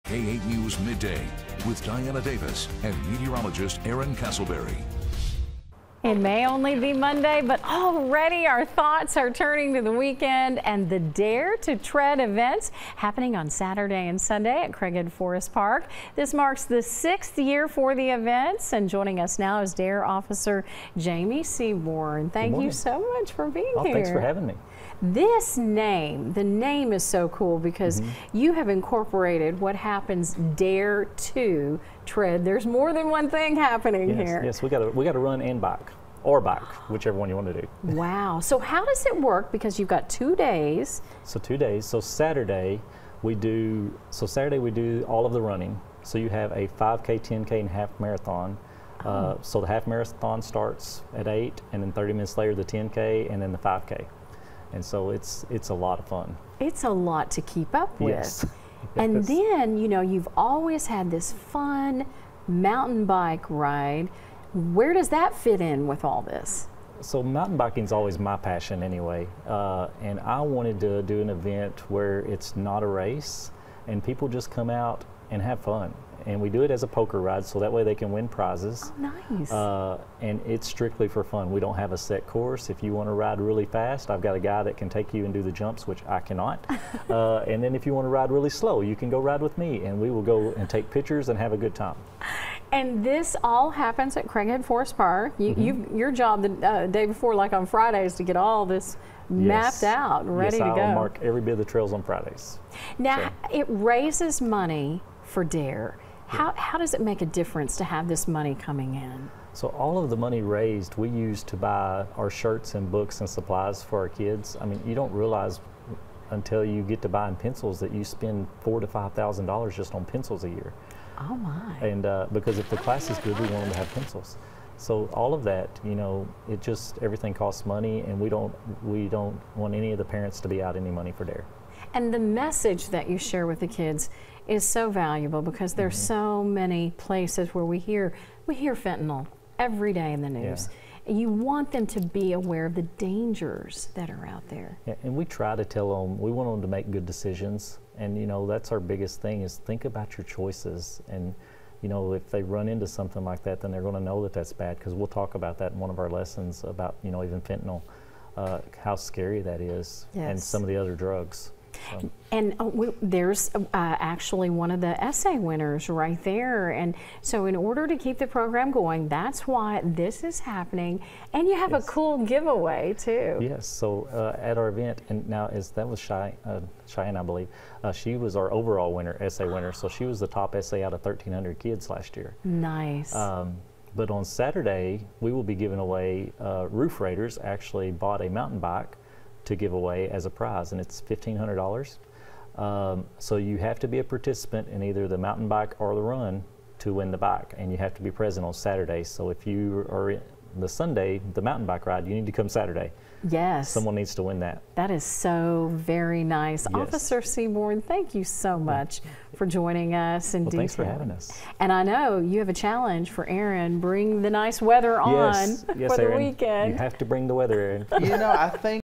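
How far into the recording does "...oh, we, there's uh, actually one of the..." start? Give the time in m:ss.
2:42.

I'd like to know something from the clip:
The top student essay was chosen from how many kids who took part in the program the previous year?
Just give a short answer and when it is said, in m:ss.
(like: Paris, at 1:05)
1,300, at 3:01.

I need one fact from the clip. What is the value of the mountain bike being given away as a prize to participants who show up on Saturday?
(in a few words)
$1,500.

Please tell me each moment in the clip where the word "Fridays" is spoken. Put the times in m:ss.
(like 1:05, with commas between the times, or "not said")
1:37, 1:42.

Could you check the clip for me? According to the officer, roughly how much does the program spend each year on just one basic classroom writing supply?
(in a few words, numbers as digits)
4,000 to 5,000 dollars.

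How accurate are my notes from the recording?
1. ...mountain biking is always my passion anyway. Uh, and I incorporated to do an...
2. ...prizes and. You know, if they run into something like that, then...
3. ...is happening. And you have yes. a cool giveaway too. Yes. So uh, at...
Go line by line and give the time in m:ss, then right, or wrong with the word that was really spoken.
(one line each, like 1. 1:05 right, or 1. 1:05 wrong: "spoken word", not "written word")
1. 1:07 wrong: "wanted", not "incorporated"
2. 2:30 wrong: "choices", not "prizes"
3. 2:50 right.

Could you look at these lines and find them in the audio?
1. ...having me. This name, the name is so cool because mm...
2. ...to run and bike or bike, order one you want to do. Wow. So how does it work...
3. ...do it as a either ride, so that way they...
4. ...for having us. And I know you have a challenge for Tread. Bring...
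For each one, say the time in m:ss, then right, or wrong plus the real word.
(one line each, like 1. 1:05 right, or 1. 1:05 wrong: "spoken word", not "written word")
1. 0:24 right
2. 0:35 wrong: "whichever", not "order"
3. 1:16 wrong: "poker", not "either"
4. 3:30 wrong: "Aaron", not "Tread".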